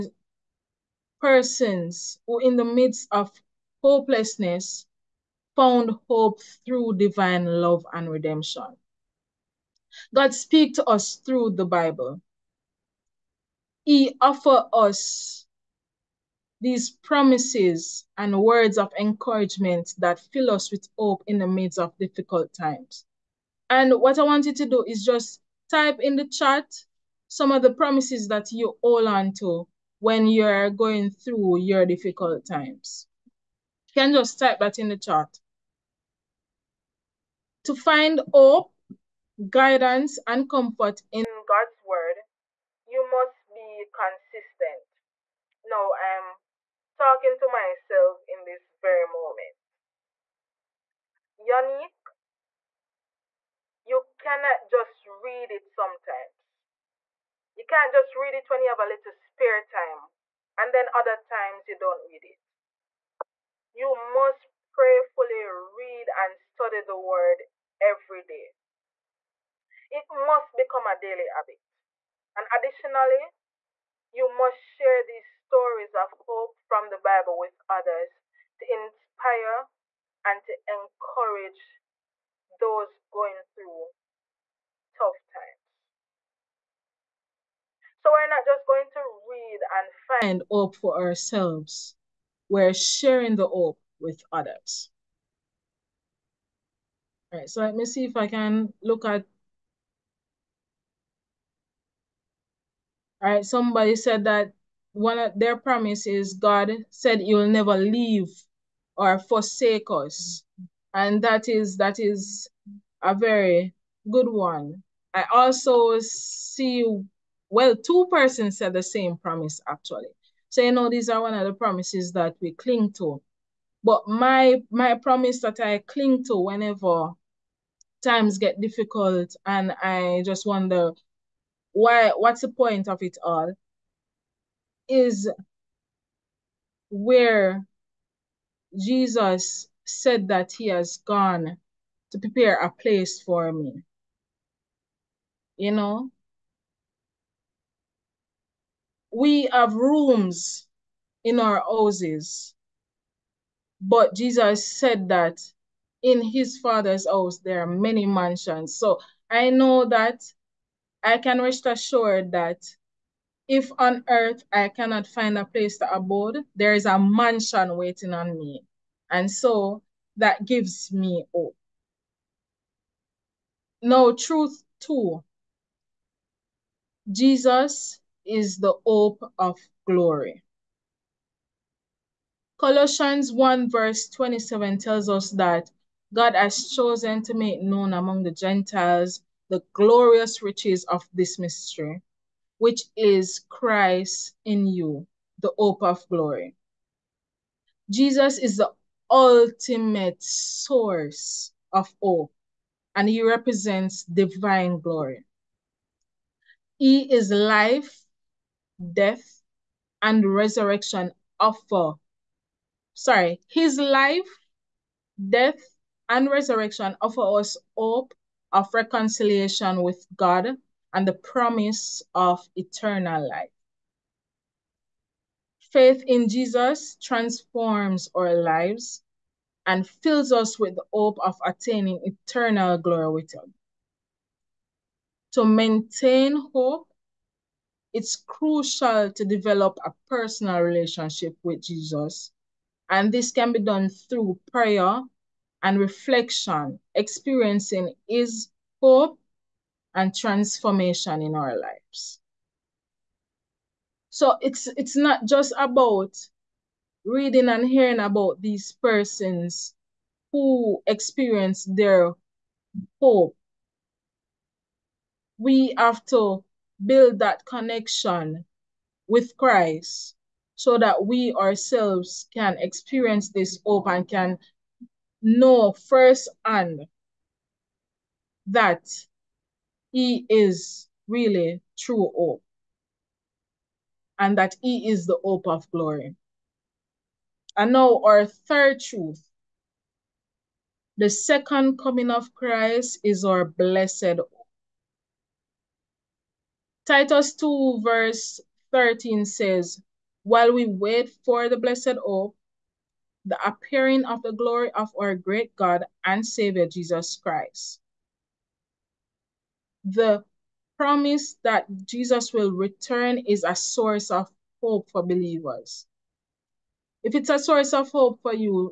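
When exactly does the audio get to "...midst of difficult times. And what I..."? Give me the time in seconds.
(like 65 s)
21 s.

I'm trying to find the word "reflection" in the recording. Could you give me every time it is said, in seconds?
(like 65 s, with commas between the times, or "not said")
245 s.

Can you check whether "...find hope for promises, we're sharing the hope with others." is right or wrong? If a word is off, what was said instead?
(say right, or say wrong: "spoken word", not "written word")
wrong: "ourselves", not "promises".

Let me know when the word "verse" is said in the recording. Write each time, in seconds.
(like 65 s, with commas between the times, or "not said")
183 s, 297 s.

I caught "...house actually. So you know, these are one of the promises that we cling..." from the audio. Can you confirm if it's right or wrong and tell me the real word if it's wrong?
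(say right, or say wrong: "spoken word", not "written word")
wrong: "promise", not "house".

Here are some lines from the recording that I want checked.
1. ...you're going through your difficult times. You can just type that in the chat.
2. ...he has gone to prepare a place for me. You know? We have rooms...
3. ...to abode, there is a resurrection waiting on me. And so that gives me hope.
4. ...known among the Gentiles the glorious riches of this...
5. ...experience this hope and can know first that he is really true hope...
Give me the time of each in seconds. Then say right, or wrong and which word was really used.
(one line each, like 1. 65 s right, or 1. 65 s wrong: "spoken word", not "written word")
1. 30 s right
2. 140 s right
3. 165 s wrong: "mansion", not "resurrection"
4. 187 s right
5. 272 s right.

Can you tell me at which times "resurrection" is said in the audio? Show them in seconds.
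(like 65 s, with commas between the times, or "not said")
210 s, 216 s.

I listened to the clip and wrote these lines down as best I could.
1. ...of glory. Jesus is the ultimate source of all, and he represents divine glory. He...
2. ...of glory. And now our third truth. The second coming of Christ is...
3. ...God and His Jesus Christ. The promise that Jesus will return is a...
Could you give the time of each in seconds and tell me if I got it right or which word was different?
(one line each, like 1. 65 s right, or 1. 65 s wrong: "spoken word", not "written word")
1. 195 s right
2. 285 s right
3. 305 s wrong: "Savior", not "His".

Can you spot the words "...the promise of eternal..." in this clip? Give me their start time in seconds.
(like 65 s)
221 s.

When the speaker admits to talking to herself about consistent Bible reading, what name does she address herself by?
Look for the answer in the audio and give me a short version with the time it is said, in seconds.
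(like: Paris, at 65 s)
Yanni, at 51 s.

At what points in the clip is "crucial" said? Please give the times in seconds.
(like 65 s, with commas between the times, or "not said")
238 s.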